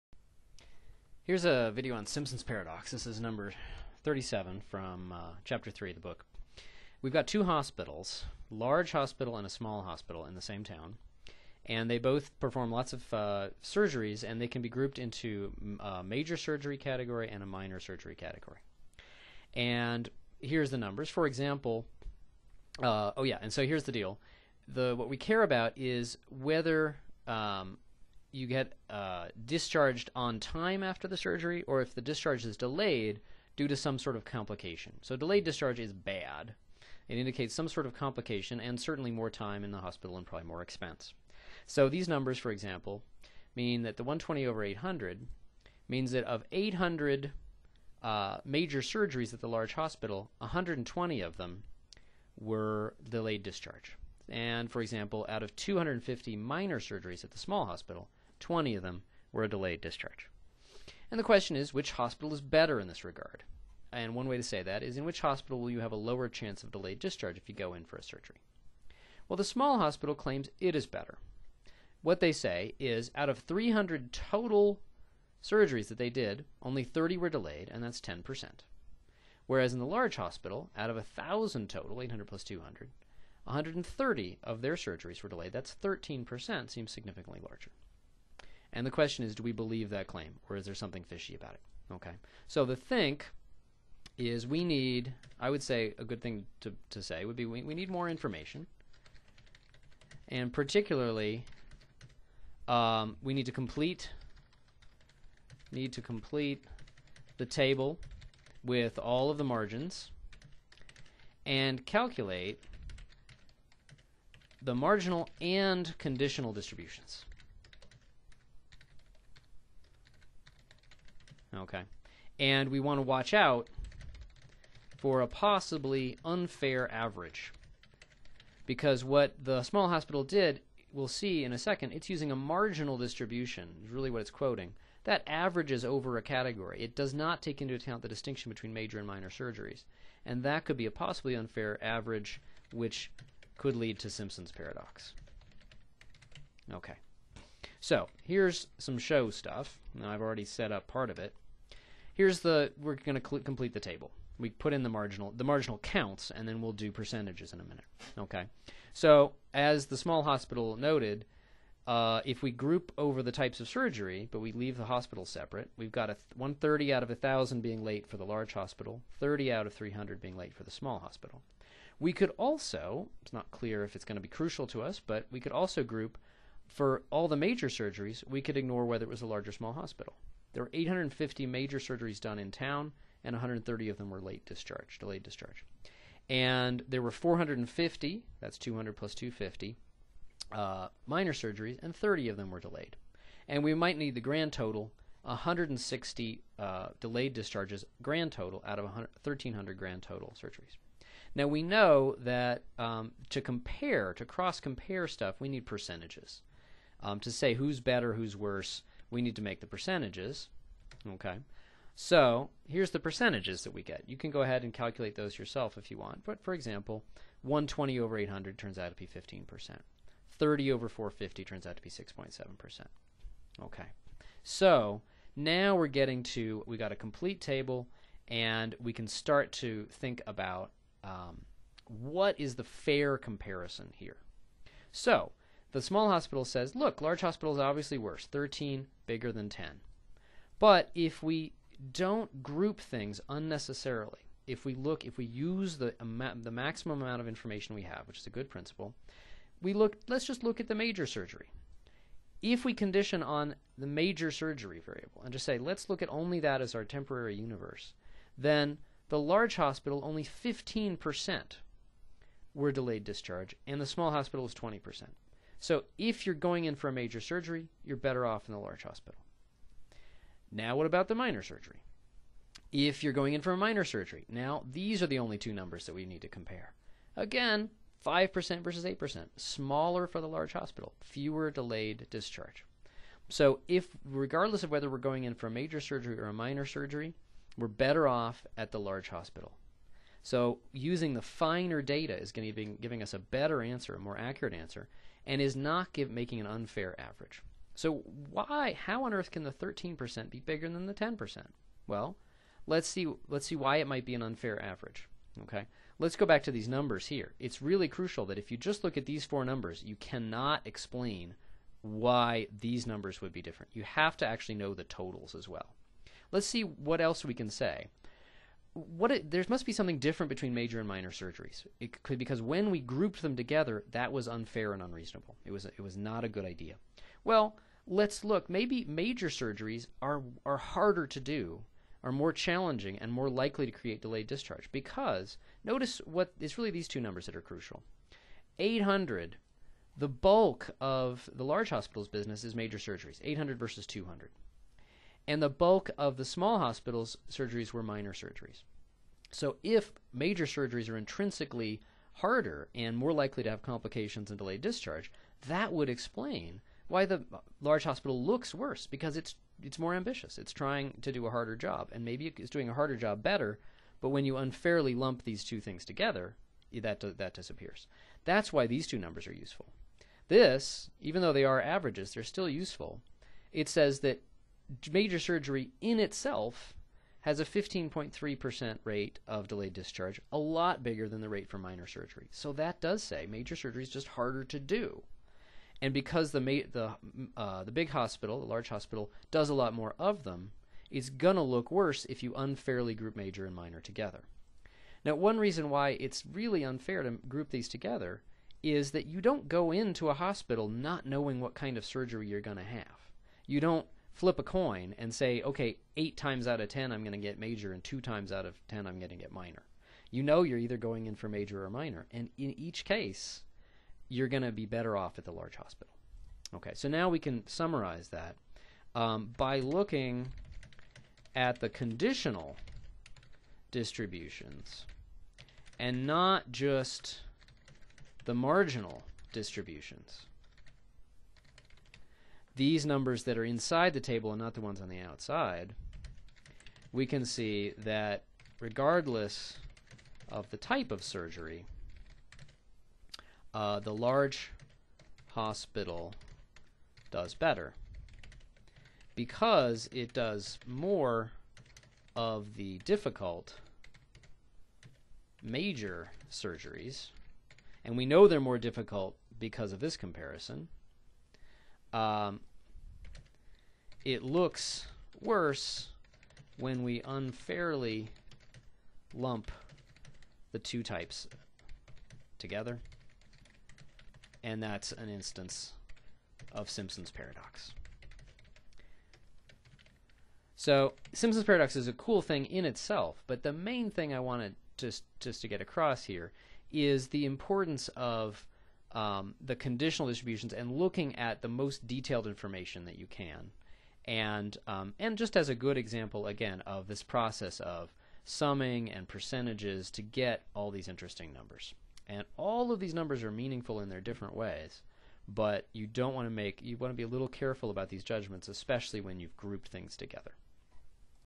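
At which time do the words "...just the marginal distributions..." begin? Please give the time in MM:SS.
07:06.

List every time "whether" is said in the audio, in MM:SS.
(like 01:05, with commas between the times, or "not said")
00:26, 02:58, 04:44.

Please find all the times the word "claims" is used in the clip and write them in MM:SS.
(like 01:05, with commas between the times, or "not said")
01:10, 01:30.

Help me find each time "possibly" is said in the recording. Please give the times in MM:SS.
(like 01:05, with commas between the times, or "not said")
02:05, 02:20.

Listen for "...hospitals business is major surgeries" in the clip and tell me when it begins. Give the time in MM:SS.
05:41.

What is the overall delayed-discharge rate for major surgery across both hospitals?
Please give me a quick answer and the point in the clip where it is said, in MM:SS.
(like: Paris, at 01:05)
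15.3%, at 06:17.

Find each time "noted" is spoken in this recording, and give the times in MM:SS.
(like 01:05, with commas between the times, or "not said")
02:40.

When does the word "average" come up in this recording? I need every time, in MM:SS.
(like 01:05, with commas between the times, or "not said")
02:06, 02:15, 02:21, 04:56, 05:04, 06:11.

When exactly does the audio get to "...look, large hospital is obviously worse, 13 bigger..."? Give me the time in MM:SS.
03:56.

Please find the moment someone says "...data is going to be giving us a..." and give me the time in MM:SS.
04:51.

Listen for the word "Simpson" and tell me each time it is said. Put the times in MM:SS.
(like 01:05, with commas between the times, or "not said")
00:02, 02:24, 07:56, 08:01.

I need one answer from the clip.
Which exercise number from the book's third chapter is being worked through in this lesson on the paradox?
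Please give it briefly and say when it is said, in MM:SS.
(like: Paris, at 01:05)
37, at 00:04.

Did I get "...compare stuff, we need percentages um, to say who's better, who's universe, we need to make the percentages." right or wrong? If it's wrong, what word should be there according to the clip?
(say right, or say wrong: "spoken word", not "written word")
wrong: "worse", not "universe".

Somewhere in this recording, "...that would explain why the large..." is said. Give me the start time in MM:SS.
05:55.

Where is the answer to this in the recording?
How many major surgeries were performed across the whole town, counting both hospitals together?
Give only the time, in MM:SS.
03:00.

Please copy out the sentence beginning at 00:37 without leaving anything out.
It indicates some sort of complication and certainly more time in the hospital and probably more expense.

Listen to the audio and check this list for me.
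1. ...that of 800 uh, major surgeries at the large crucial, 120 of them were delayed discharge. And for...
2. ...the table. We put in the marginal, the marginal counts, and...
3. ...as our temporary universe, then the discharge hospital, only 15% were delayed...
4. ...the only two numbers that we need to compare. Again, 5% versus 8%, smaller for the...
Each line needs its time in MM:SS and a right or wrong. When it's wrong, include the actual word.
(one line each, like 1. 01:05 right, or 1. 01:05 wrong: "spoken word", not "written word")
1. 00:46 wrong: "hospital", not "crucial"
2. 02:33 right
3. 04:16 wrong: "large", not "discharge"
4. 04:35 right.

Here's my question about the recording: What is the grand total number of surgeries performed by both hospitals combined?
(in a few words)
1,300.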